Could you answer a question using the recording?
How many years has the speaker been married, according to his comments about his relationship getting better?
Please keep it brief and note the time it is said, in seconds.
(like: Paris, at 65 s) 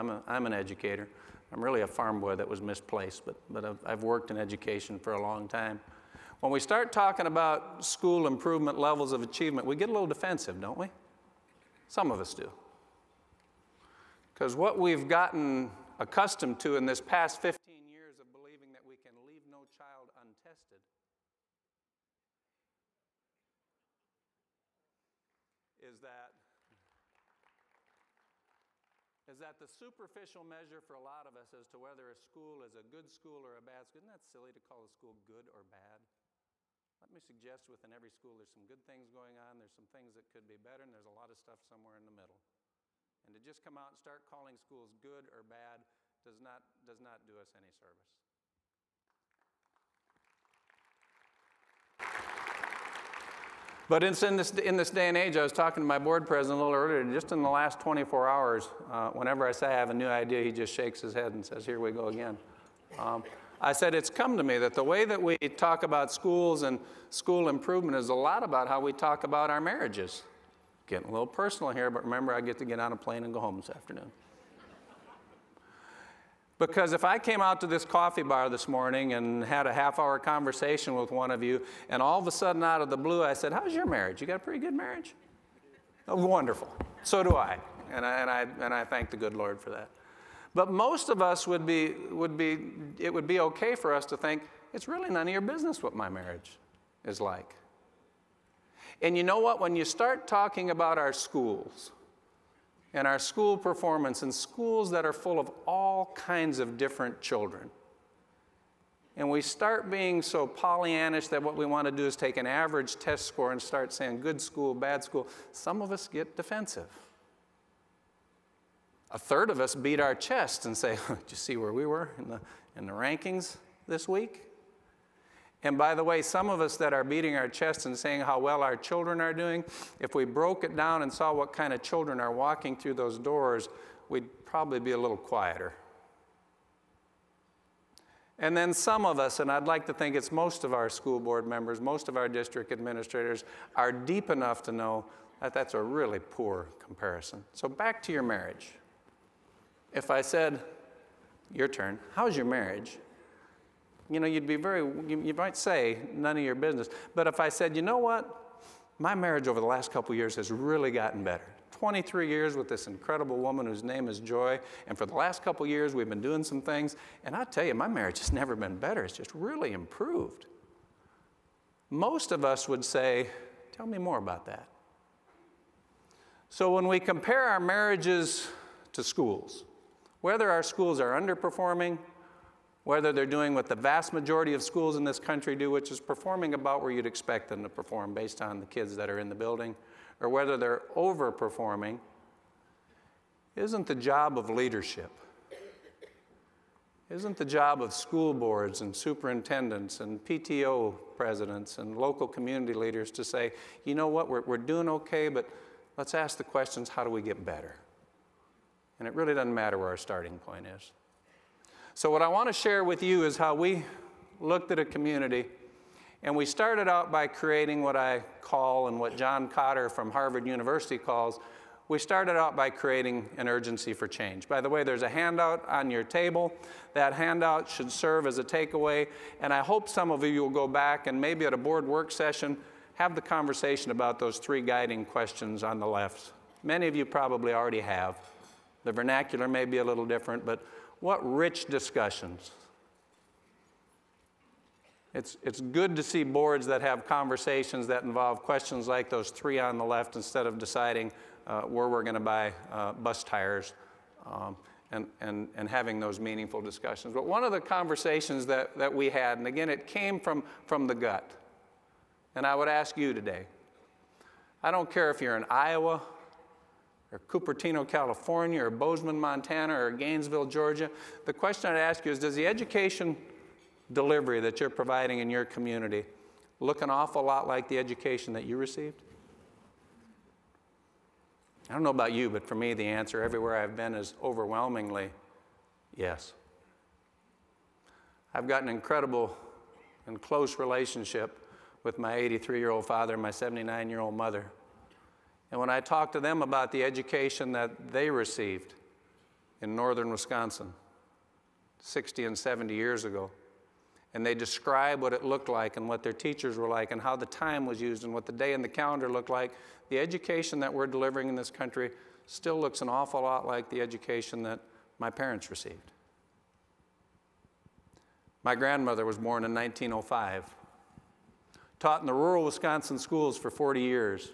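23, at 161 s.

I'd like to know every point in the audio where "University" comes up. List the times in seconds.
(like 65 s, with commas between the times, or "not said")
220 s.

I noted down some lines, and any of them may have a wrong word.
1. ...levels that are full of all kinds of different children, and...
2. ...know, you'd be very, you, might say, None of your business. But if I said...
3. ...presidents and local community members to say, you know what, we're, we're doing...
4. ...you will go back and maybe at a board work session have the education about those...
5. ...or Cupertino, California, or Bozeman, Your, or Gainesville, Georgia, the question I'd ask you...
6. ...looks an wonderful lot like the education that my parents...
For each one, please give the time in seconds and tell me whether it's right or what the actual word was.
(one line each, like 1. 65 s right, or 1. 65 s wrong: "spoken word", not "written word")
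1. 104 s wrong: "schools", not "levels"
2. 154 s right
3. 201 s wrong: "leaders", not "members"
4. 230 s wrong: "conversation", not "education"
5. 267 s wrong: "Montana", not "Your"
6. 312 s wrong: "awful", not "wonderful".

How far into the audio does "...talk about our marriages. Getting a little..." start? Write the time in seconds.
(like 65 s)
68 s.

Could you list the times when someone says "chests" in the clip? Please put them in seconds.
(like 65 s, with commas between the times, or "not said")
120 s, 127 s.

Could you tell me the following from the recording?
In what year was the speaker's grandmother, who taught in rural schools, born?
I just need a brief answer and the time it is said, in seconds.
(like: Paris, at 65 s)
1905, at 319 s.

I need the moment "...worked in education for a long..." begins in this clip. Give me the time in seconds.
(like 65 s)
4 s.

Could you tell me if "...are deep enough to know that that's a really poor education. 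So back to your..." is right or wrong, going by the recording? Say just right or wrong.
wrong.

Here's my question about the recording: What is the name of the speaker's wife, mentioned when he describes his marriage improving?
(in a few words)
Joy.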